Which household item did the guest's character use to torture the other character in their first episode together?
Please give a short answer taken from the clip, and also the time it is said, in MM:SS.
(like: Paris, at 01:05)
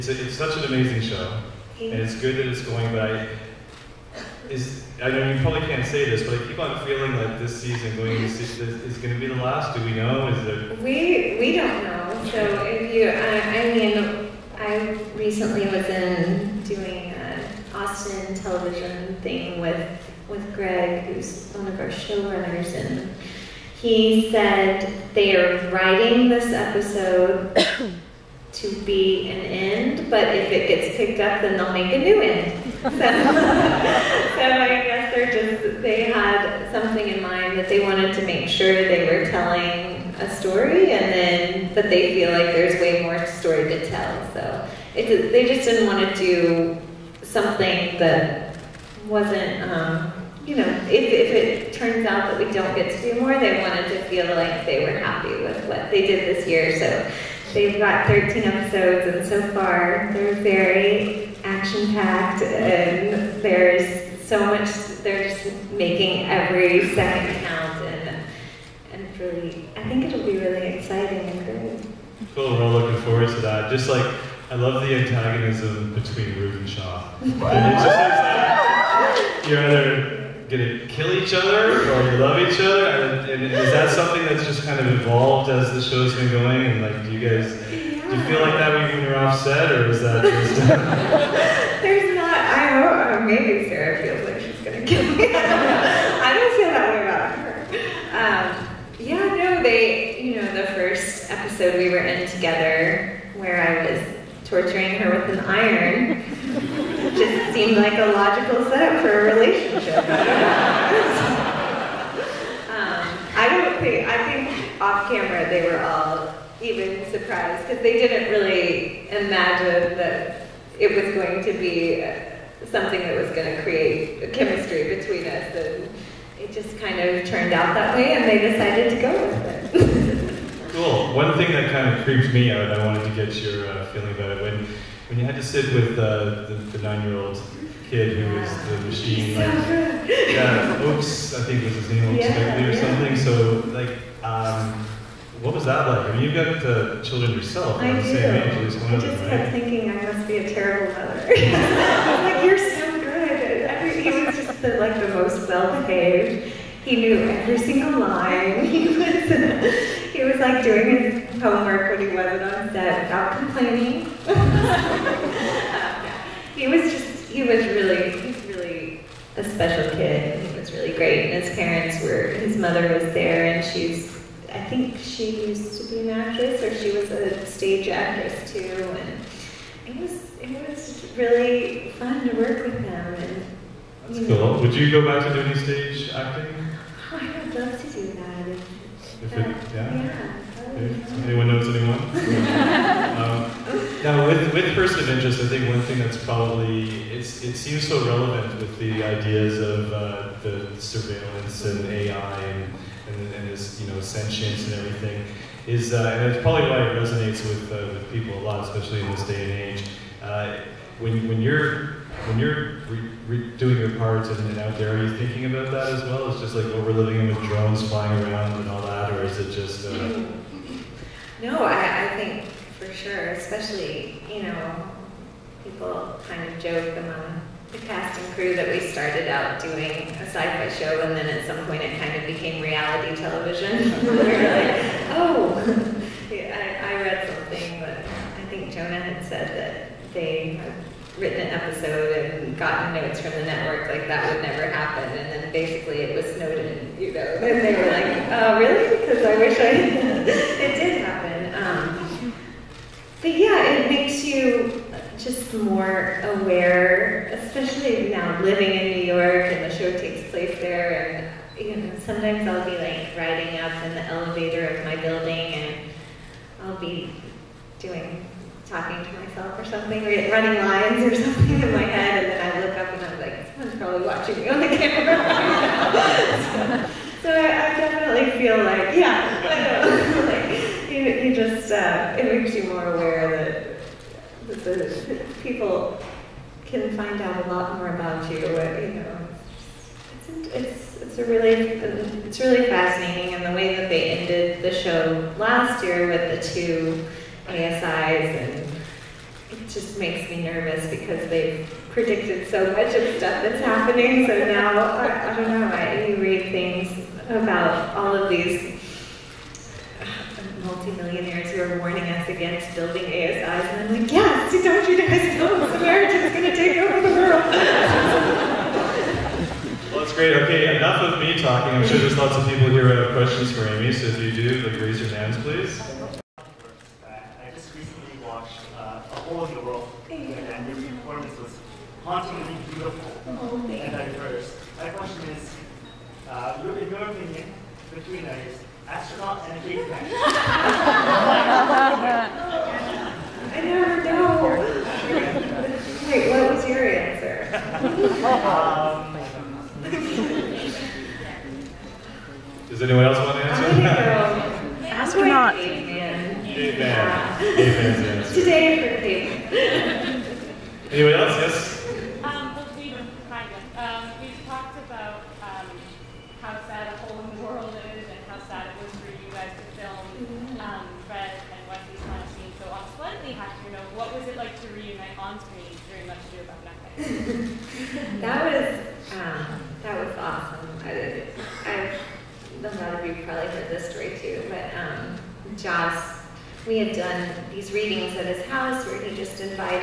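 An iron, at 01:45.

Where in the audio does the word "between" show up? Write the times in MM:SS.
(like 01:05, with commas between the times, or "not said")
01:15, 02:04, 05:37.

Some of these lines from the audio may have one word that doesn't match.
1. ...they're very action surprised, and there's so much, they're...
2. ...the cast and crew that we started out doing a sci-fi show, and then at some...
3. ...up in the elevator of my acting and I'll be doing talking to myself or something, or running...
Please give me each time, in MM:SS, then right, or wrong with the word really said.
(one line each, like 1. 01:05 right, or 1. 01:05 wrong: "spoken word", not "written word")
1. 01:00 wrong: "packed", not "surprised"
2. 03:47 right
3. 04:23 wrong: "building", not "acting".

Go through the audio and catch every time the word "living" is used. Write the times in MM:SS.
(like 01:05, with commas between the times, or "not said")
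03:36, 04:18.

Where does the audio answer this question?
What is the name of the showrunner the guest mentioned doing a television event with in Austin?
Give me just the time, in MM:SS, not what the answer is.
00:20.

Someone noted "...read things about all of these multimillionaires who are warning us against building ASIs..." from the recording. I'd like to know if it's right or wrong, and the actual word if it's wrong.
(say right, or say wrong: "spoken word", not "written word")
right.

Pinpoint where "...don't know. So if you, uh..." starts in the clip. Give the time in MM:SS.
00:11.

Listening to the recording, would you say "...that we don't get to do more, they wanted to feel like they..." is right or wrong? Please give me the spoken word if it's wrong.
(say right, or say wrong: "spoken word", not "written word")
right.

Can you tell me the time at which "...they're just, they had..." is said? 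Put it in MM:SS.
00:35.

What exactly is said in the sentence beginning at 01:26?
And like, do you guys yeah.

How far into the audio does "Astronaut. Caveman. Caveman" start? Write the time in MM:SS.
05:54.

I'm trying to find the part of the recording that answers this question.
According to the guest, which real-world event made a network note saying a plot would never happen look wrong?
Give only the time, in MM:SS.
04:06.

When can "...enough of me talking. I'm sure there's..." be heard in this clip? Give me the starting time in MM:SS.
05:20.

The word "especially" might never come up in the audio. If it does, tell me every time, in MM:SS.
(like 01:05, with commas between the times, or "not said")
03:28, 03:43, 04:17.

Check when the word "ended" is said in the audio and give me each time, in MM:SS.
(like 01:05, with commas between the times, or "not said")
04:54.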